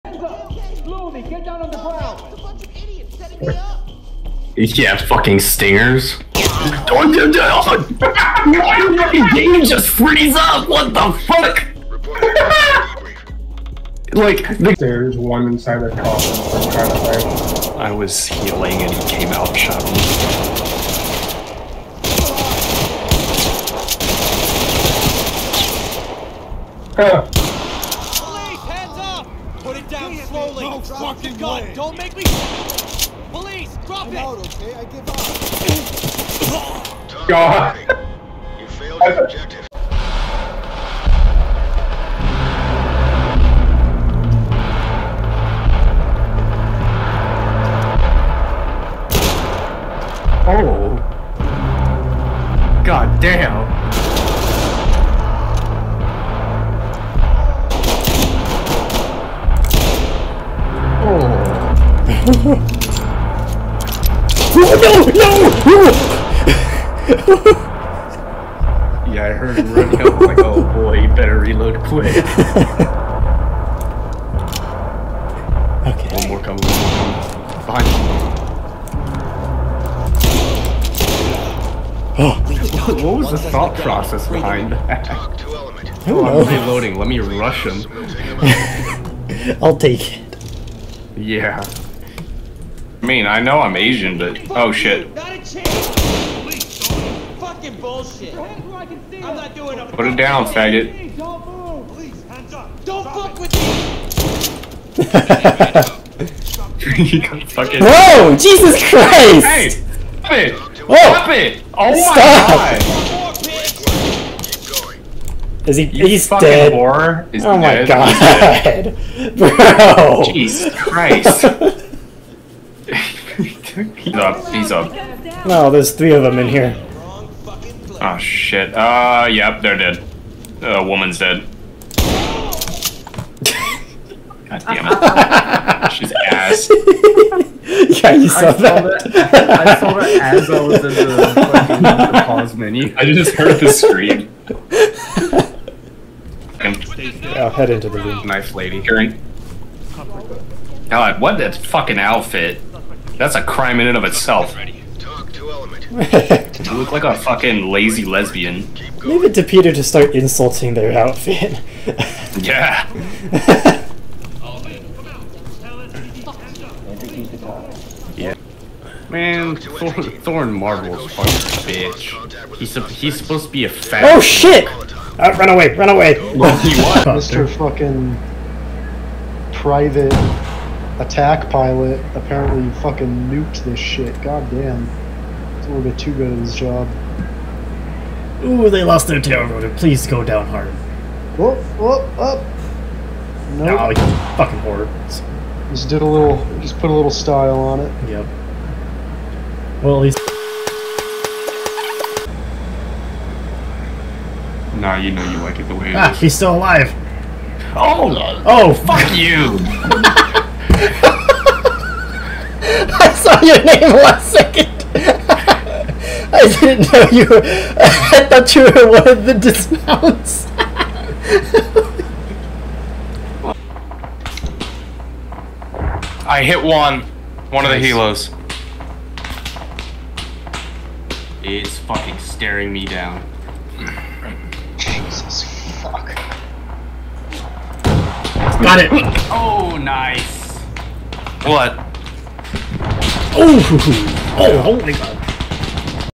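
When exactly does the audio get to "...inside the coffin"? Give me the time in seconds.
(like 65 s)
15 s.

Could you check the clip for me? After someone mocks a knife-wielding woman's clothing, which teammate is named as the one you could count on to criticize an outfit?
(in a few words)
Peter.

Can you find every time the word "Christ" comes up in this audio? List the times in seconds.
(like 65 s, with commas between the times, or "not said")
108 s, 120 s.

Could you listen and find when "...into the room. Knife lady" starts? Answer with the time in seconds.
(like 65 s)
147 s.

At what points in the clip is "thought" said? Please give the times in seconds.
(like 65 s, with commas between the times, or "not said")
83 s, 218 s.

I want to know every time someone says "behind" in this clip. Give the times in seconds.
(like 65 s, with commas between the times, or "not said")
77 s, 84 s.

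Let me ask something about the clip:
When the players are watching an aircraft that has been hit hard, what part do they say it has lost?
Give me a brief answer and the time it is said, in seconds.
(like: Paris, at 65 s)
Tail rotor, at 189 s.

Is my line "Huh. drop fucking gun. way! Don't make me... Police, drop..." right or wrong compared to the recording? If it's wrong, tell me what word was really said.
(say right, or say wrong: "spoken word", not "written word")
right.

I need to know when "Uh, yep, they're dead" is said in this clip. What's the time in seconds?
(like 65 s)
128 s.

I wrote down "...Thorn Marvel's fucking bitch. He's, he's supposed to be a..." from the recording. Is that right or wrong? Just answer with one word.
right.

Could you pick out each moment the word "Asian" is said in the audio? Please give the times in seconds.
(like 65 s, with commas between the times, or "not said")
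93 s.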